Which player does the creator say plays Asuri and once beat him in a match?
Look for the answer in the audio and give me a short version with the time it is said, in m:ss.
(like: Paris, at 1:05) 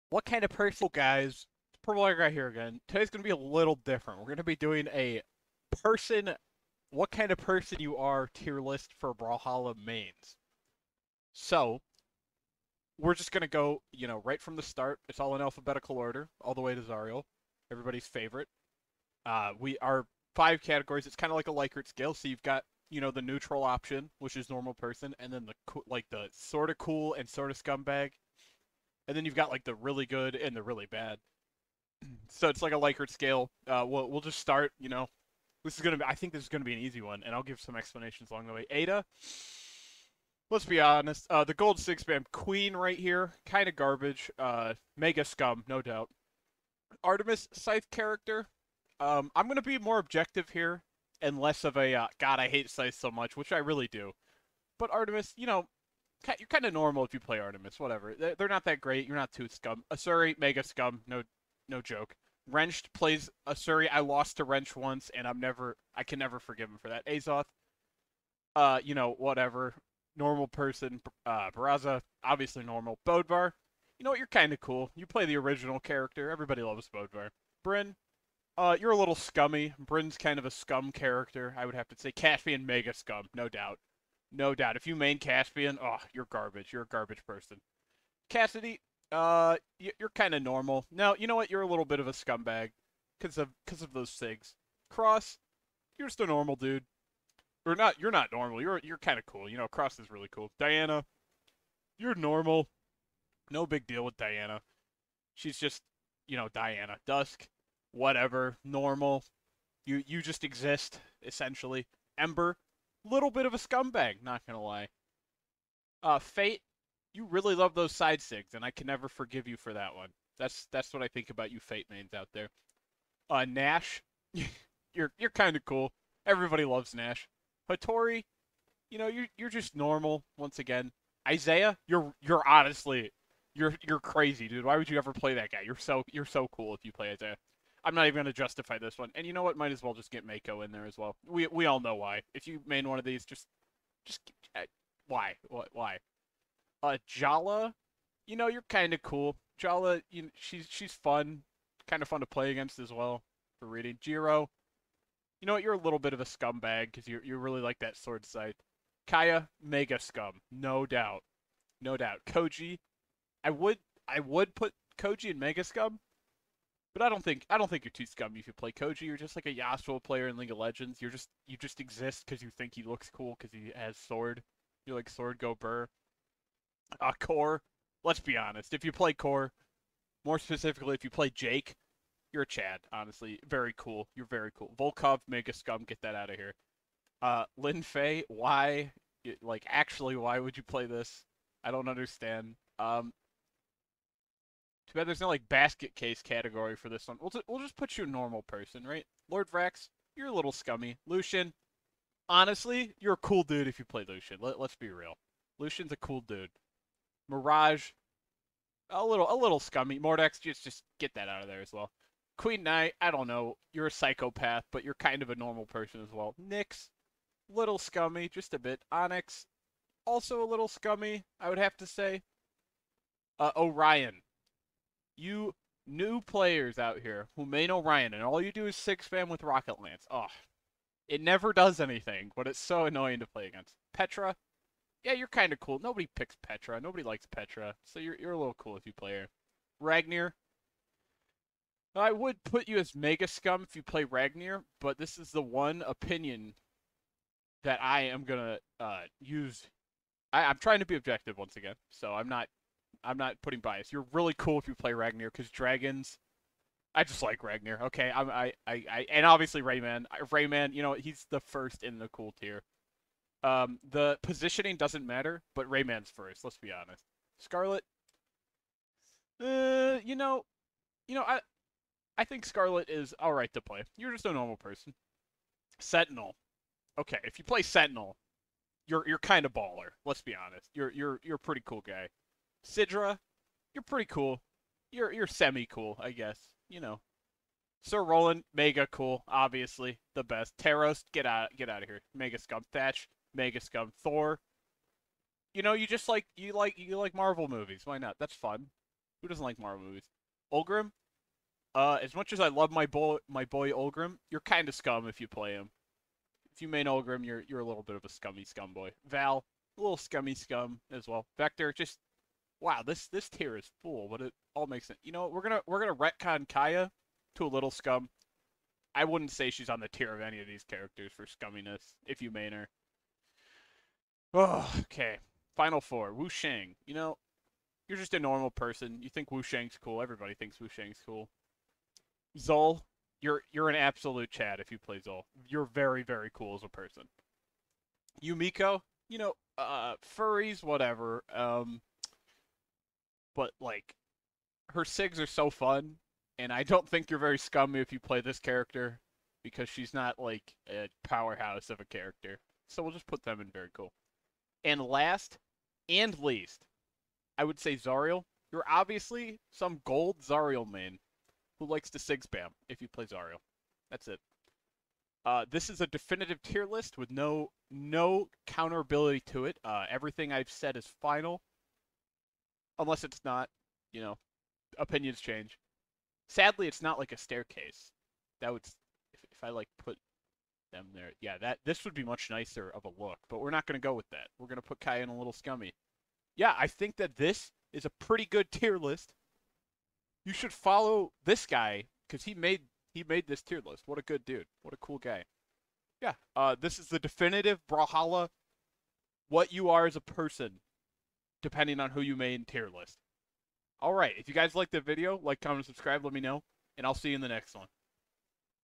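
Wrench, at 1:04.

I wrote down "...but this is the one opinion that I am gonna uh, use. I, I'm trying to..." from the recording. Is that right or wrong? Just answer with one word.
right.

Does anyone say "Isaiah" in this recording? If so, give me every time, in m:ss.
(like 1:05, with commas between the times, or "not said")
2:11, 2:17.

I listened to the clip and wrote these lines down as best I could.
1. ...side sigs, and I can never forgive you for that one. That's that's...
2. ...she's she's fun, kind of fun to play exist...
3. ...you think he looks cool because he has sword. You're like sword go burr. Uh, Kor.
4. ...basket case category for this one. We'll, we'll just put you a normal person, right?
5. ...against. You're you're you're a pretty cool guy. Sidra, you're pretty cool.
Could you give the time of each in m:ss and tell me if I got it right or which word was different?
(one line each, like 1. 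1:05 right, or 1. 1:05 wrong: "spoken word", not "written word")
1. 1:57 right
2. 2:30 wrong: "against", not "exist"
3. 2:52 right
4. 3:15 right
5. 4:40 wrong: "honest", not "against".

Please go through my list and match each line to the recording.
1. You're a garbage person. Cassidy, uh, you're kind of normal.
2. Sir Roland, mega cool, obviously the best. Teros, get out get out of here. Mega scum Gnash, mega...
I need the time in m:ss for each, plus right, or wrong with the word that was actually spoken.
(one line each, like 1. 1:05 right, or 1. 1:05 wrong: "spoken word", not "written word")
1. 1:26 right
2. 4:47 wrong: "Thatch", not "Gnash".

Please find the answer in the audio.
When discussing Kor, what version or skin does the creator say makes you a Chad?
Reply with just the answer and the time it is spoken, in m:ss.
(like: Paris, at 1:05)
Jake, at 3:01.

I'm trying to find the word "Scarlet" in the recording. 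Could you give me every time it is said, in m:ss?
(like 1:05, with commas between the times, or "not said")
4:27, 4:32.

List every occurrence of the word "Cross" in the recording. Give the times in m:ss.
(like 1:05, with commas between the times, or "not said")
1:34, 1:39.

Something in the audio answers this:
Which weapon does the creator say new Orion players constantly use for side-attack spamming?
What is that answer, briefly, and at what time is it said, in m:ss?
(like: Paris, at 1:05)
Rocket Lance, at 3:49.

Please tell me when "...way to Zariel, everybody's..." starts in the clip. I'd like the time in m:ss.
0:16.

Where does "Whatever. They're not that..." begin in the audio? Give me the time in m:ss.
0:57.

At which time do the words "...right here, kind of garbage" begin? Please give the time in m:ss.
0:42.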